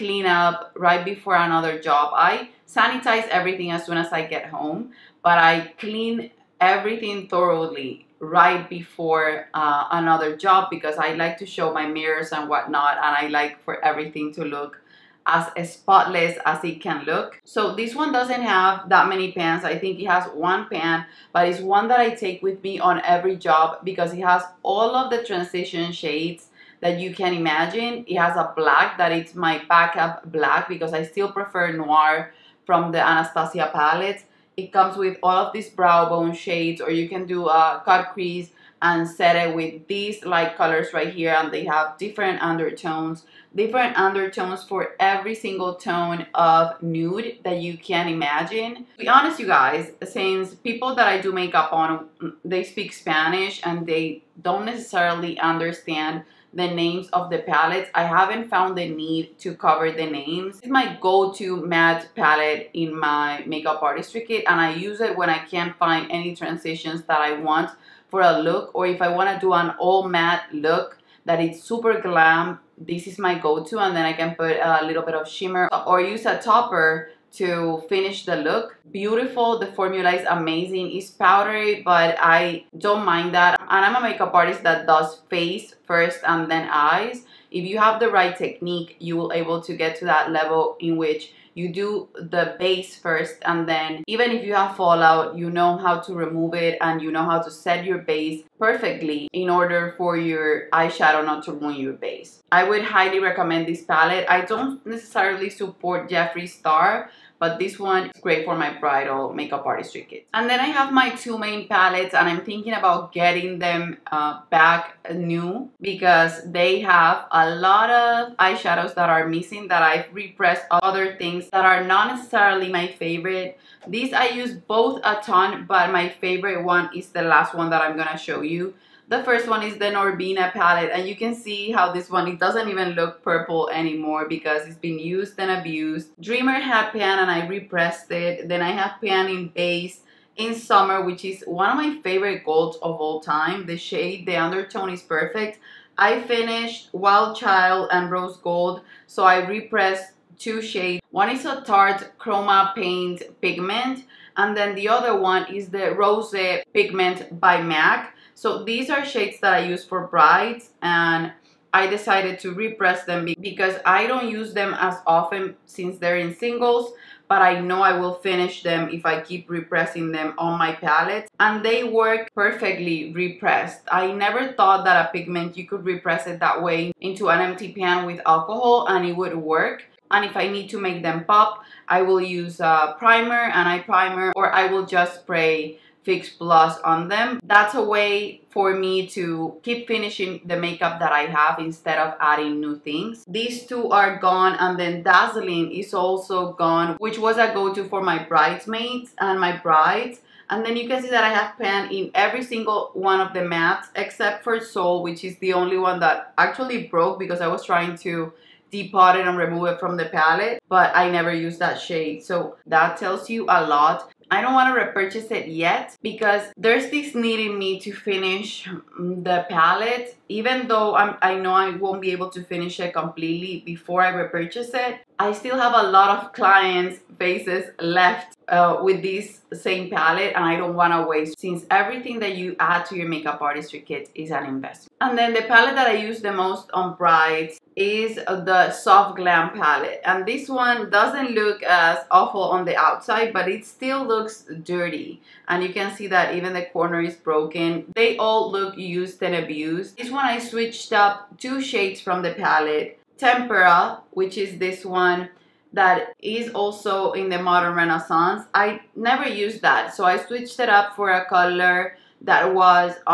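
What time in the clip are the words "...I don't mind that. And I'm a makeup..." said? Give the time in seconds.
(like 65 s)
82 s.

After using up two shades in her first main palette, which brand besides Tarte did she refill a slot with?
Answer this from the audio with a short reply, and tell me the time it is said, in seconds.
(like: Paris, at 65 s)
MAC, at 157 s.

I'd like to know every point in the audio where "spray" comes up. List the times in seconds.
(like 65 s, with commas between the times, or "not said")
185 s.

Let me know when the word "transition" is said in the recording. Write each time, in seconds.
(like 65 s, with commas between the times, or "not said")
25 s, 66 s.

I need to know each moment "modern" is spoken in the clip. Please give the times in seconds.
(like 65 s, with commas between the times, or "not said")
257 s.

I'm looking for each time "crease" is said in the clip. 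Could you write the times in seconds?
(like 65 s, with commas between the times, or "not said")
38 s.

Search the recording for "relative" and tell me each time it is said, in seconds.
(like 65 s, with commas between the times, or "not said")
not said.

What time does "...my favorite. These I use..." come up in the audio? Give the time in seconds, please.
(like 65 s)
122 s.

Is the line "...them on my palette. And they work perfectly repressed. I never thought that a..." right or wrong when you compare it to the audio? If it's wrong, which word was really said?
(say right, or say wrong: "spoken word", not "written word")
right.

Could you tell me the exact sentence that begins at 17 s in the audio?
So this one doesn't have that many pans.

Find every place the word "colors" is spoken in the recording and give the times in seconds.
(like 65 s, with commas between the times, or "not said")
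40 s, 261 s.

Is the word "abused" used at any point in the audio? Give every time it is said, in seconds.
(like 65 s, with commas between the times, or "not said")
135 s, 249 s.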